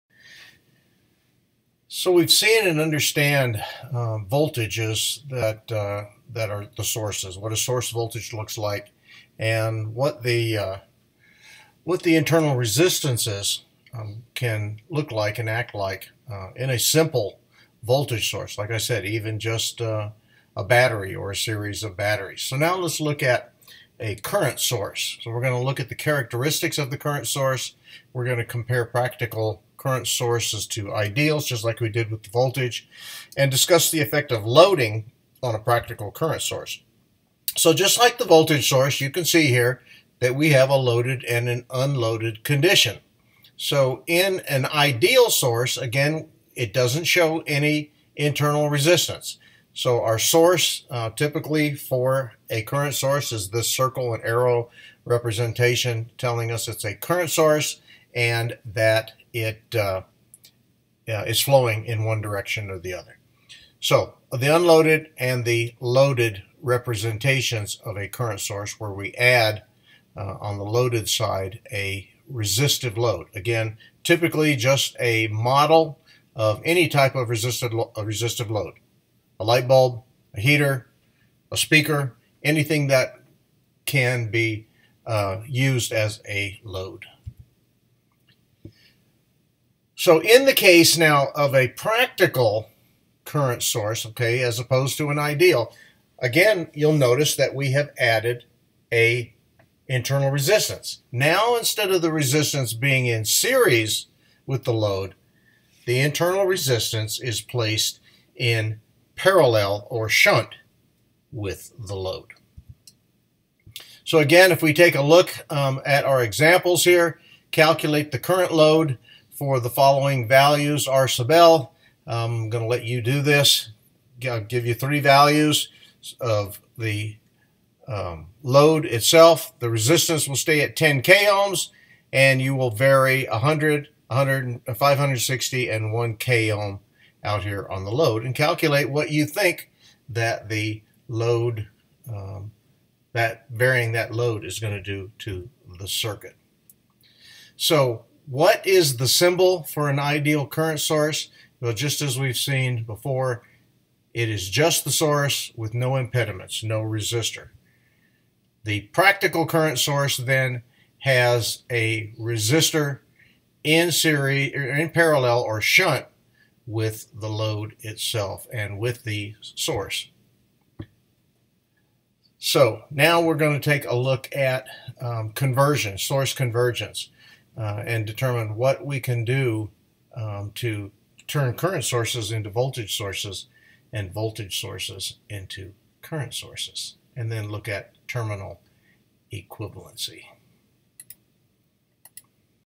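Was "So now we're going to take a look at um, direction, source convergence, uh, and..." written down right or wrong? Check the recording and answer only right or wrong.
wrong.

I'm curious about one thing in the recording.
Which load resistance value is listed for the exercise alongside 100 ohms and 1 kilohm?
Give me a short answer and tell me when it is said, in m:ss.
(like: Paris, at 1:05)
560 ohms, at 2:14.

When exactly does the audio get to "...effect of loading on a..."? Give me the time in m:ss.
0:34.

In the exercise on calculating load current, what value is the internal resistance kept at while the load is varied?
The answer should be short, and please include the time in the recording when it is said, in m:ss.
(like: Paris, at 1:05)
10 kilohms, at 2:10.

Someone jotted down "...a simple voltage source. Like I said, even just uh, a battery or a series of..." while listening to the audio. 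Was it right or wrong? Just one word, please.
right.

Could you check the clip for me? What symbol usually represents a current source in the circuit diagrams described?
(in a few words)
Circle and arrow.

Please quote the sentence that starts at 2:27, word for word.
So what is the symbol for an ideal current source?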